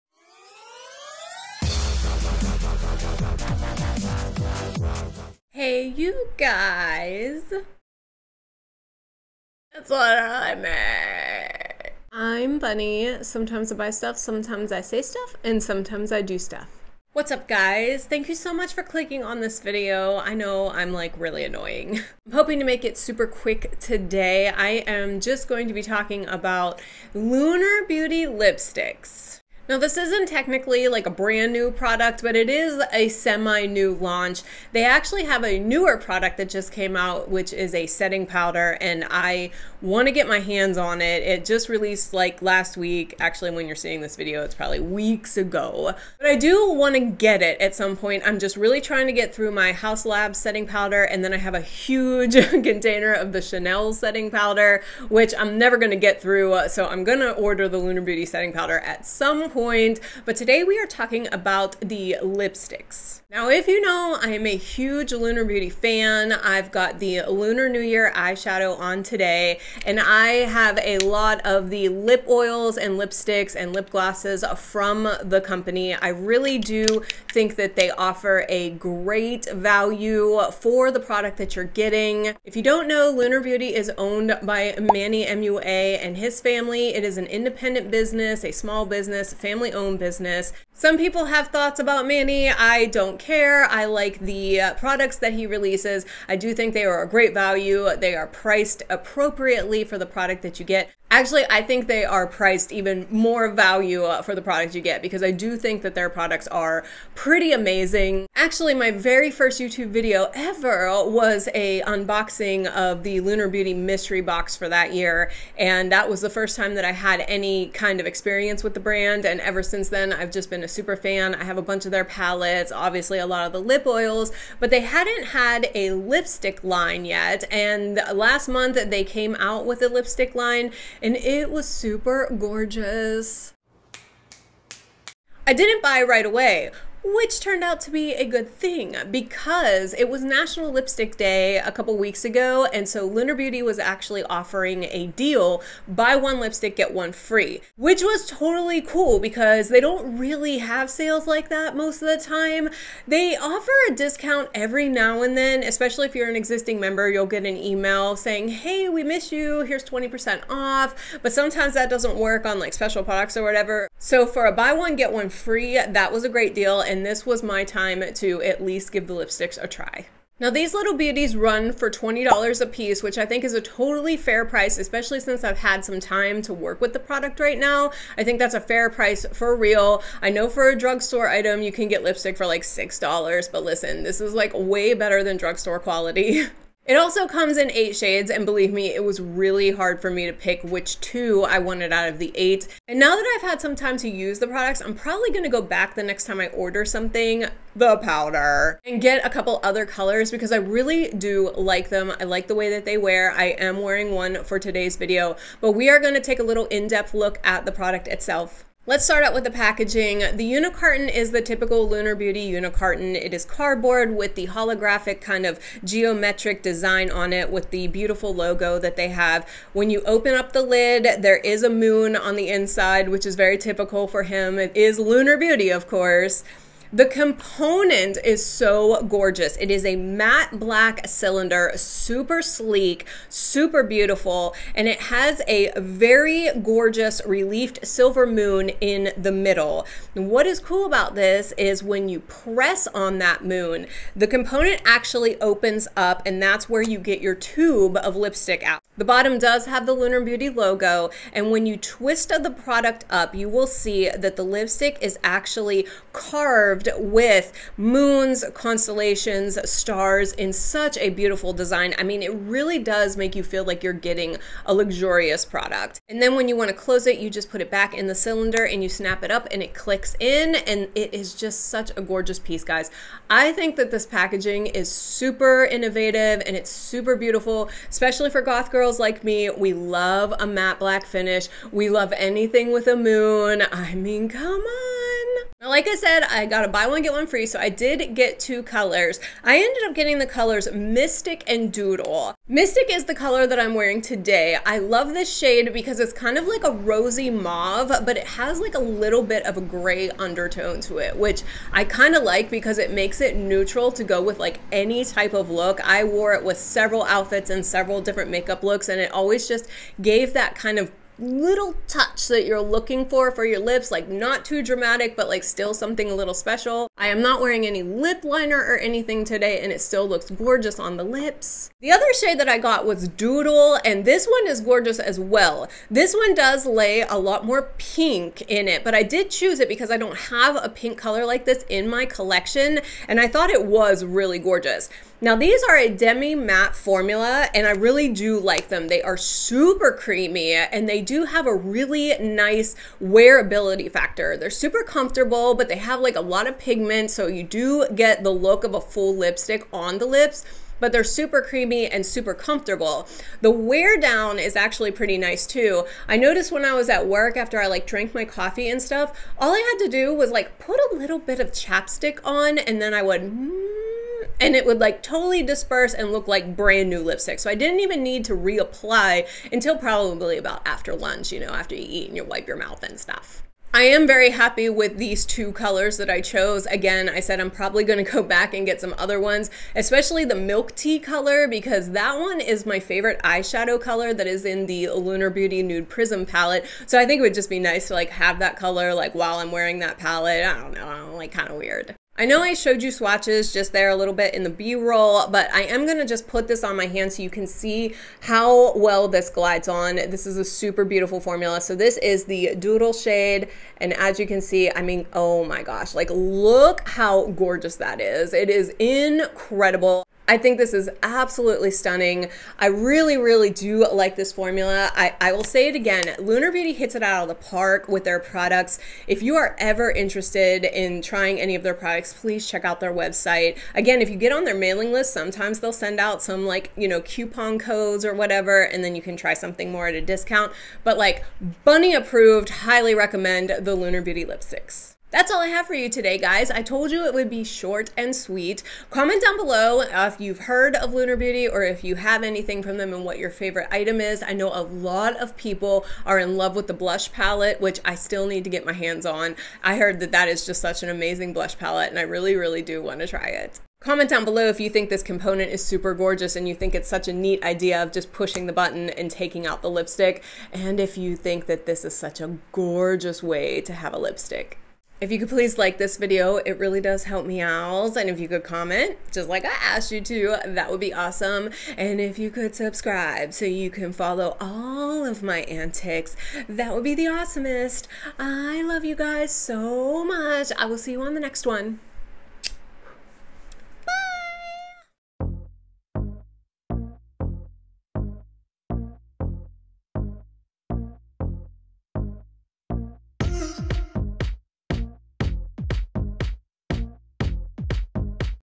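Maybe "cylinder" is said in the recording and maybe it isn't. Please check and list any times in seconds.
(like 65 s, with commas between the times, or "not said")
231 s, 268 s.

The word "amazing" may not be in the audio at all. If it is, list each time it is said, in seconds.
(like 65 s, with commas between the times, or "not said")
107 s, 450 s.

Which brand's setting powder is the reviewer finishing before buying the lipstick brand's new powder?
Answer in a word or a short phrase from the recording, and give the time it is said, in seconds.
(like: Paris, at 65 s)
Haus Lab, at 49 s.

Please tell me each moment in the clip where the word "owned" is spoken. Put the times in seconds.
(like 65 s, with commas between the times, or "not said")
83 s, 89 s.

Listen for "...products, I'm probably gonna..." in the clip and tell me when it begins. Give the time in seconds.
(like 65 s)
194 s.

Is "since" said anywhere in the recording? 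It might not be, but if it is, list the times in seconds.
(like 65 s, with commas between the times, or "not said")
119 s, 175 s.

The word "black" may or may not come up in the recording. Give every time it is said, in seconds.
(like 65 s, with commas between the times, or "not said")
230 s, 280 s.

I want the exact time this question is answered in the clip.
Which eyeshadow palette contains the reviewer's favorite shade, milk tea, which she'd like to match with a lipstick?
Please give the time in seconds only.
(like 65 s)
385 s.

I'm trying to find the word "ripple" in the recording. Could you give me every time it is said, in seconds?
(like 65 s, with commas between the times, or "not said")
not said.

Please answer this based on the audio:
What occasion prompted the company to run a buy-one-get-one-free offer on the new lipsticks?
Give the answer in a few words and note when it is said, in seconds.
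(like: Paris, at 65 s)
National Lipstick Day, at 140 s.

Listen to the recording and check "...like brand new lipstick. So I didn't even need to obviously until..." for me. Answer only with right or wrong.
wrong.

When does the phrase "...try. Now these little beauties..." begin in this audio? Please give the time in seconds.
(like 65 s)
169 s.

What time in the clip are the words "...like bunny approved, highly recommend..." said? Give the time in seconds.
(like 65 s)
430 s.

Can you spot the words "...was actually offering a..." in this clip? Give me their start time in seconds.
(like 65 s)
143 s.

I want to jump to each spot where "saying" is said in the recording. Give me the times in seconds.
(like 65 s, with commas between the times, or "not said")
158 s.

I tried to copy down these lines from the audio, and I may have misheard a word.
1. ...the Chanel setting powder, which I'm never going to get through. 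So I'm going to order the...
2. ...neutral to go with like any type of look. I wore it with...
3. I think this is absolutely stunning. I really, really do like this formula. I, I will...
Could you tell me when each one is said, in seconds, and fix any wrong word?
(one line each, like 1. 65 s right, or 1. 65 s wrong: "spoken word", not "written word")
1. 53 s right
2. 303 s right
3. 410 s right.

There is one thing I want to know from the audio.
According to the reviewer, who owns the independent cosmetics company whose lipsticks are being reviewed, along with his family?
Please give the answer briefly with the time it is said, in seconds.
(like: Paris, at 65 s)
Manny MUA, at 84 s.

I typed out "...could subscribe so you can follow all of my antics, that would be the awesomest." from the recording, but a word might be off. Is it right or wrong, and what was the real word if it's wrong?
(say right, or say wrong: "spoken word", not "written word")
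right.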